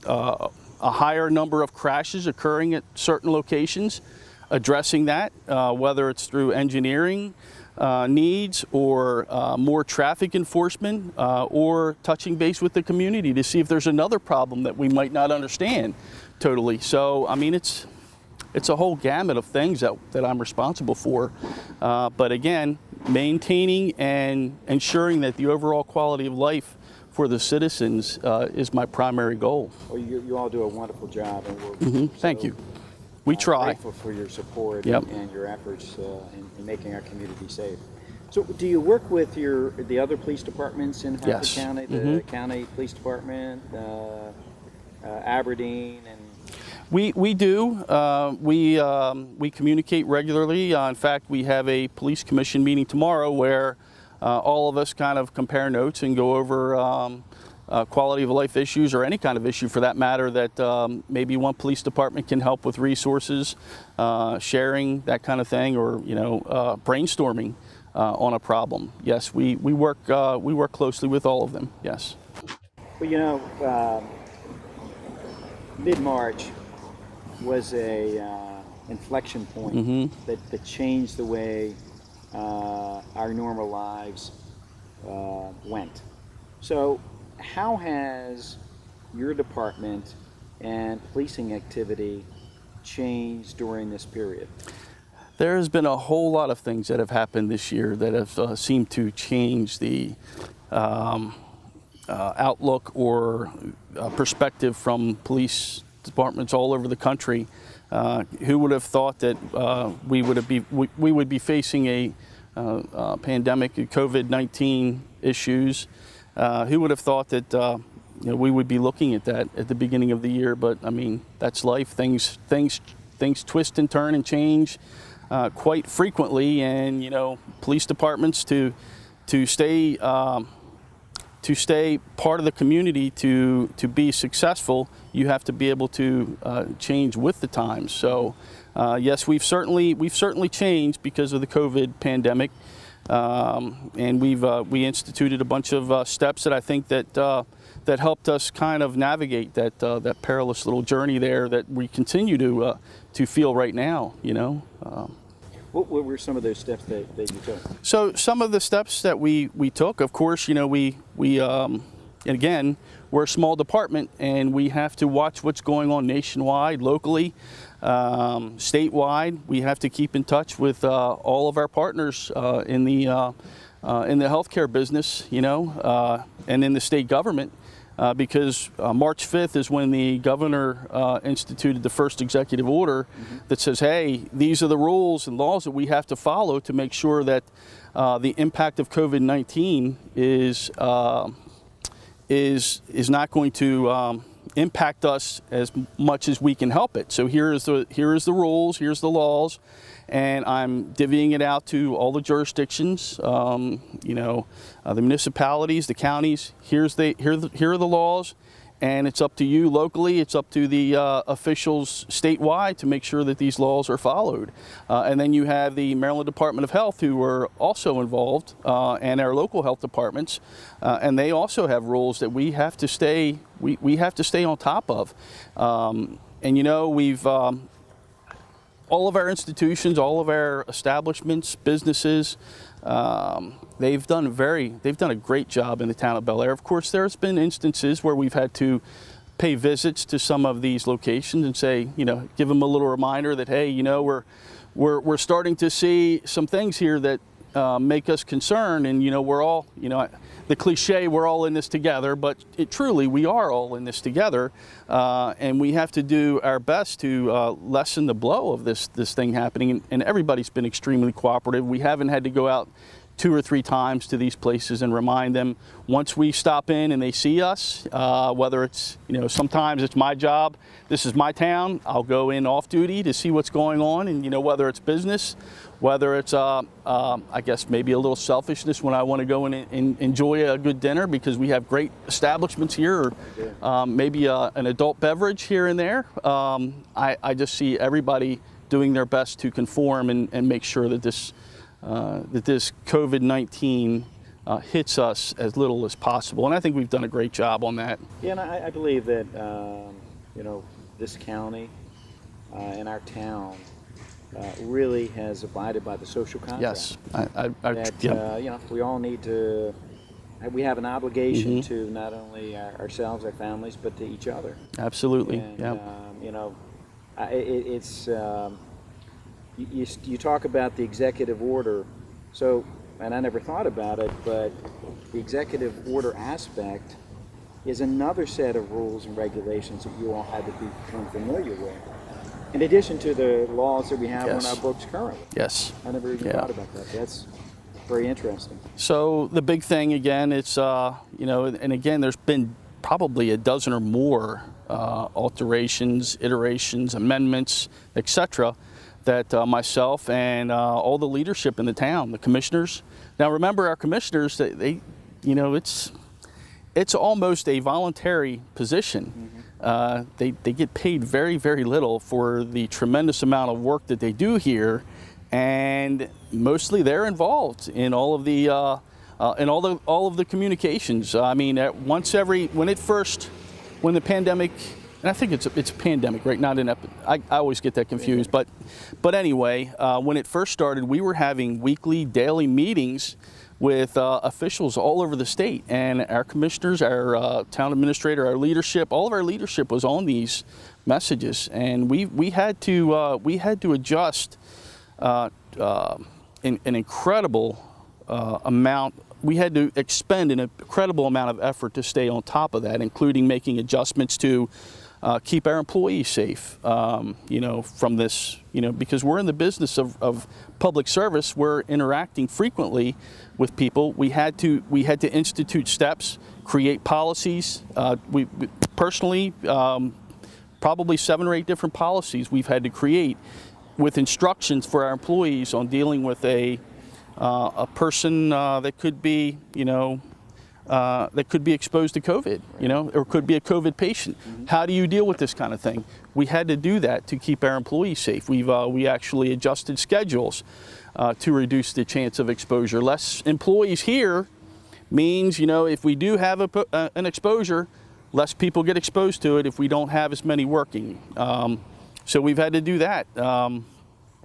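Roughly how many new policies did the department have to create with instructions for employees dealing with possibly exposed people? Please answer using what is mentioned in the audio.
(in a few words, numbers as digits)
7 or 8.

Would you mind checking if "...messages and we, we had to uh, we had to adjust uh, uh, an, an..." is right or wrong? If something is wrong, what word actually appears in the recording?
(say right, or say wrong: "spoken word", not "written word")
right.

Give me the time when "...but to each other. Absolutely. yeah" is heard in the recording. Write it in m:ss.
5:13.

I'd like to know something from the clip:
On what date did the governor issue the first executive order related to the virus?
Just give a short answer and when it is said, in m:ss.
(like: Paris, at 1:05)
March 5th, at 2:58.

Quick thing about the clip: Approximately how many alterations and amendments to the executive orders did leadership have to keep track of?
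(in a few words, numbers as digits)
a dozen.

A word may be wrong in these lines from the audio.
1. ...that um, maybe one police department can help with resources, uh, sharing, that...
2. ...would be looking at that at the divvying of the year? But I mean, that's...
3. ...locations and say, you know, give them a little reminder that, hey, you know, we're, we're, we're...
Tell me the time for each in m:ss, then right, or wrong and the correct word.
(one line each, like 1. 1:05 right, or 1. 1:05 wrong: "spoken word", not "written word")
1. 1:00 right
2. 1:58 wrong: "beginning", not "divvying"
3. 4:00 right.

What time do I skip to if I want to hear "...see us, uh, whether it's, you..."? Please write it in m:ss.
4:27.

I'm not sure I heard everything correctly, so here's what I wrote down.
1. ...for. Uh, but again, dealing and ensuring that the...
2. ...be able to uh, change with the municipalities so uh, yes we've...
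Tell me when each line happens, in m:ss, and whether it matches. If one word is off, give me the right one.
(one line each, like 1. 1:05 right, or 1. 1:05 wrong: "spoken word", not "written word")
1. 0:20 wrong: "maintaining", not "dealing"
2. 2:15 wrong: "times", not "municipalities".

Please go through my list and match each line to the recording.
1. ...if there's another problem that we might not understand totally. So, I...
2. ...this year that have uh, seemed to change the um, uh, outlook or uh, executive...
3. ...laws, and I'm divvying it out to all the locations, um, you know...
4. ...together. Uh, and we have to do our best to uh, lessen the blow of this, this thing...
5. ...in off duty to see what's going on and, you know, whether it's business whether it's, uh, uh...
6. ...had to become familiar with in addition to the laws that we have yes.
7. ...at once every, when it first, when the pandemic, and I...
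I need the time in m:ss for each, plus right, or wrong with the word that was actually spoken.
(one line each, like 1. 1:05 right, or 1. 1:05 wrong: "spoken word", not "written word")
1. 0:13 right
2. 1:37 wrong: "perspective", not "executive"
3. 3:19 wrong: "jurisdictions", not "locations"
4. 4:14 right
5. 4:32 right
6. 5:30 right
7. 6:11 right.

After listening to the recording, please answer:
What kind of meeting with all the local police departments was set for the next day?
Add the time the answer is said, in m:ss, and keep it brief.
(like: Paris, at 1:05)
police commission meeting, at 0:51.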